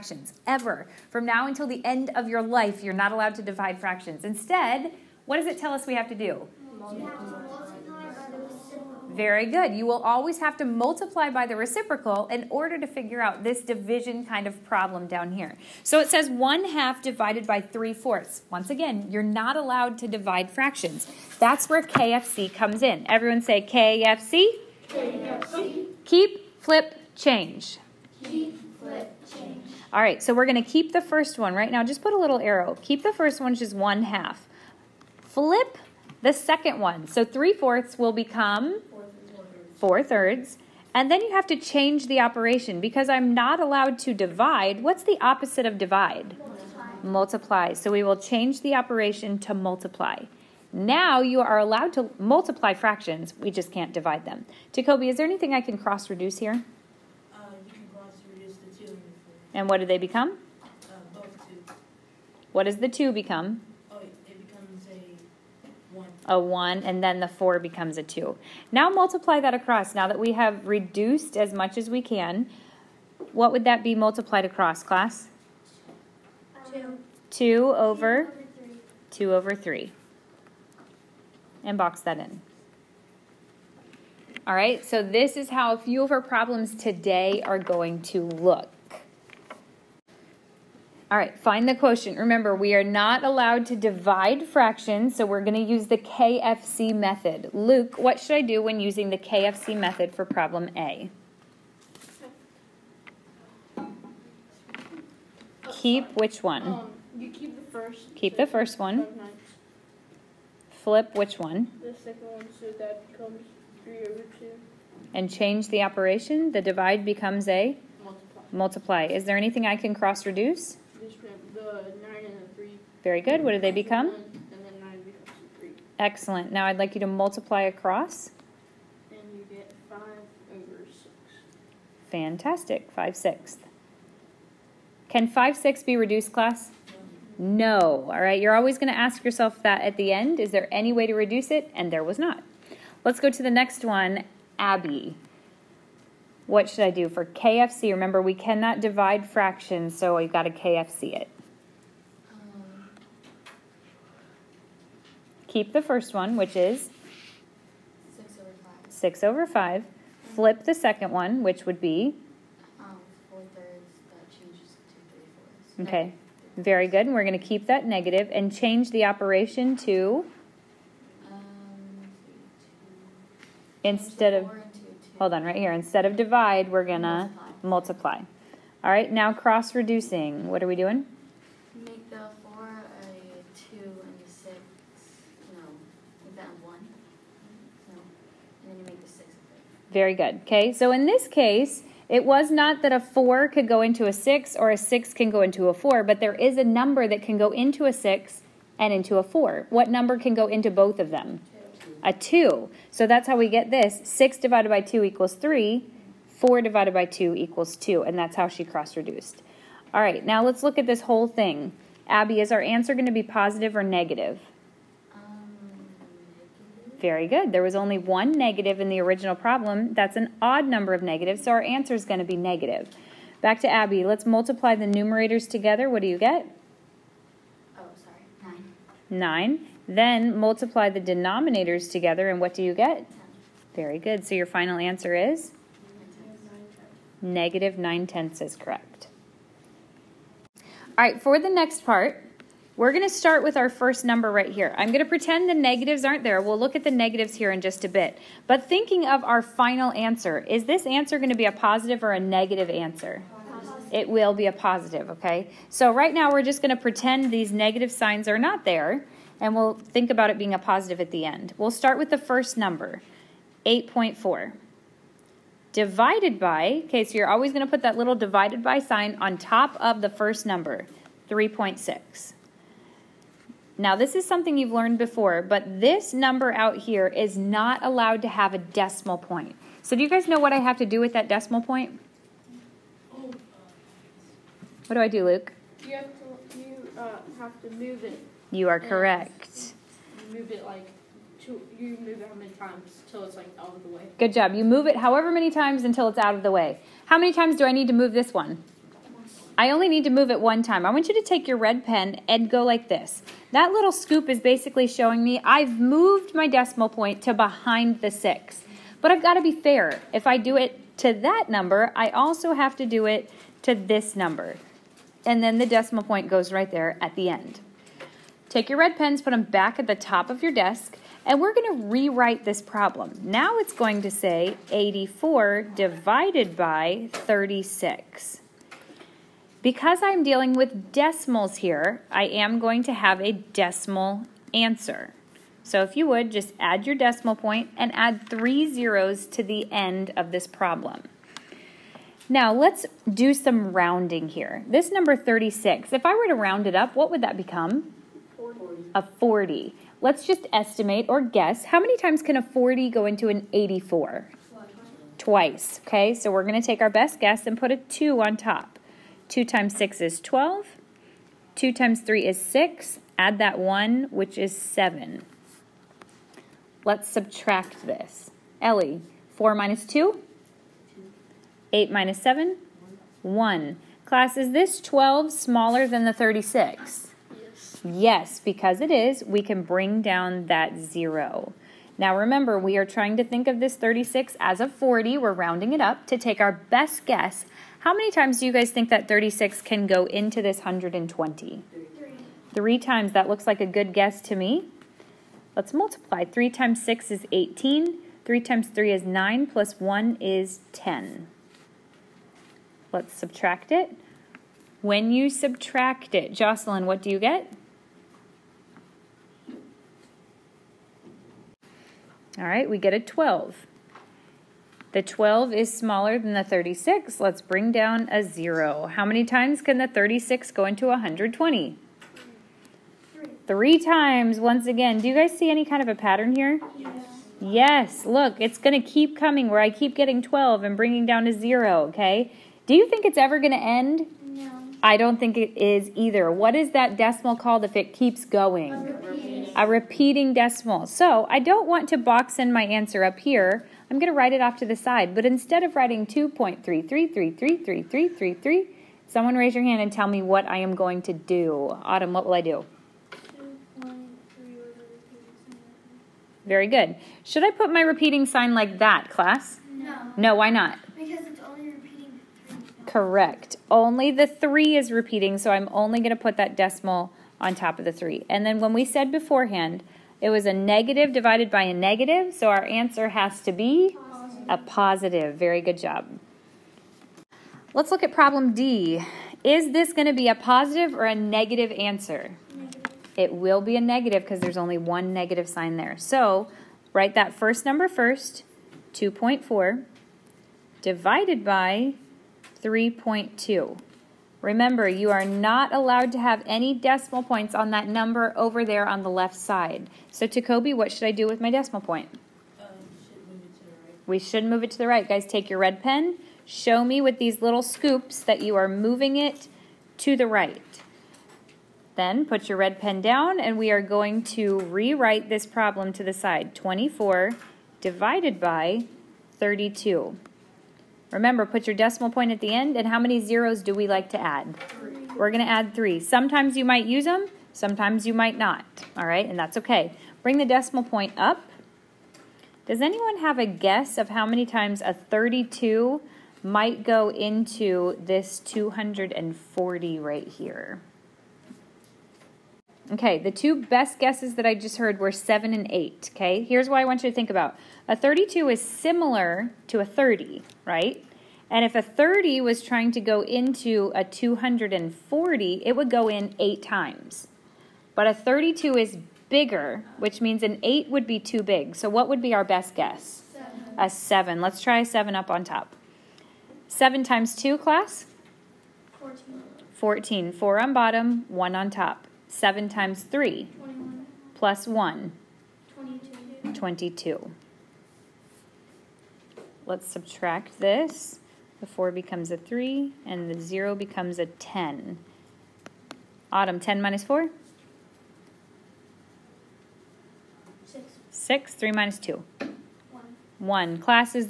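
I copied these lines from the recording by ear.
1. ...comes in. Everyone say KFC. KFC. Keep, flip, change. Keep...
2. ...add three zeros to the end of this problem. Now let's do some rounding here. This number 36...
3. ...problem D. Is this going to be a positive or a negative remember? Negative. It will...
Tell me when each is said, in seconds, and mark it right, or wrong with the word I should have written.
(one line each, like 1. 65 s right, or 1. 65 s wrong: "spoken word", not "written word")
1. 22 s right
2. 337 s right
3. 478 s wrong: "answer", not "remember".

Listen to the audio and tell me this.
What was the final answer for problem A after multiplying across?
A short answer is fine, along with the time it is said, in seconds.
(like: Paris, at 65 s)
5 over 6, at 129 s.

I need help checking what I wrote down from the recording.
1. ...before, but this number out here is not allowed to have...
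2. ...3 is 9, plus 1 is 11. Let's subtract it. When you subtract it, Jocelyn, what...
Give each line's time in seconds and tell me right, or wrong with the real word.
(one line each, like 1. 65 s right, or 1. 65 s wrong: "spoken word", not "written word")
1. 274 s right
2. 398 s wrong: "10", not "11".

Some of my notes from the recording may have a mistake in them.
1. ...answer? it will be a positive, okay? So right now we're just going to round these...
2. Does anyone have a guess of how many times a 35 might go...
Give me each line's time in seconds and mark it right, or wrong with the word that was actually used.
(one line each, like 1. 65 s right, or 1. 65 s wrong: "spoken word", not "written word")
1. 252 s wrong: "pretend", not "round"
2. 532 s wrong: "32", not "35".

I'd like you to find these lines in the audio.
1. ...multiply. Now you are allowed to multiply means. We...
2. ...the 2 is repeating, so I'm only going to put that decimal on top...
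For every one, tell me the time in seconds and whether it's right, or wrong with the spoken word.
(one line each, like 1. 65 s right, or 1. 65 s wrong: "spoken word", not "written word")
1. 49 s wrong: "fractions", not "means"
2. 464 s wrong: "3", not "2".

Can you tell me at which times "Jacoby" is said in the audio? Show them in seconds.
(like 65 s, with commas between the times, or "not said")
54 s, 500 s.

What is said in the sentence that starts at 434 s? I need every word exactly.
I don't think it is either.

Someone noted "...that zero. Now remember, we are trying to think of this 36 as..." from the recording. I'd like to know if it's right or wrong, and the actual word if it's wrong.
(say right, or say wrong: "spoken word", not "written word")
right.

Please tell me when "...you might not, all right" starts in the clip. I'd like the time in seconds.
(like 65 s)
528 s.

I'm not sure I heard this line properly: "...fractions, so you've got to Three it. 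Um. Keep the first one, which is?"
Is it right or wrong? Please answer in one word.
wrong.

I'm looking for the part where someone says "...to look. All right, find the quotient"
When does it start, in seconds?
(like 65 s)
88 s.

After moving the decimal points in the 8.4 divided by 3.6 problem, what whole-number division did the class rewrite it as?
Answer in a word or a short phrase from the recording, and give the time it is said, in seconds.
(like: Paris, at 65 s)
84 divided by 36, at 324 s.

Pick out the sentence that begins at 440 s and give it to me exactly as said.
So I don't want to box in my answer up here.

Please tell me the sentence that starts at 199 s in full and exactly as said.
What number can go into both of them?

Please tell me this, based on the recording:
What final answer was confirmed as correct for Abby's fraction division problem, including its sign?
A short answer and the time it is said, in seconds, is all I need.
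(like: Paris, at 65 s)
Negative 9 tenths, at 237 s.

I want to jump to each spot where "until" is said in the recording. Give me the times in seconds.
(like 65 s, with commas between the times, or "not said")
1 s, 295 s.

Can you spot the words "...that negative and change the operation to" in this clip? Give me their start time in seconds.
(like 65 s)
167 s.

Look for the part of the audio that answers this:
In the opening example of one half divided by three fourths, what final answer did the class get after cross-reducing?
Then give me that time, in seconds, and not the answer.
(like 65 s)
79 s.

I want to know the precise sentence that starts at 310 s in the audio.
If I do it to that number, I also have to do it to this number.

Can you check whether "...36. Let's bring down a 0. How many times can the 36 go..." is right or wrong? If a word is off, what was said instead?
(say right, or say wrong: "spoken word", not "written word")
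right.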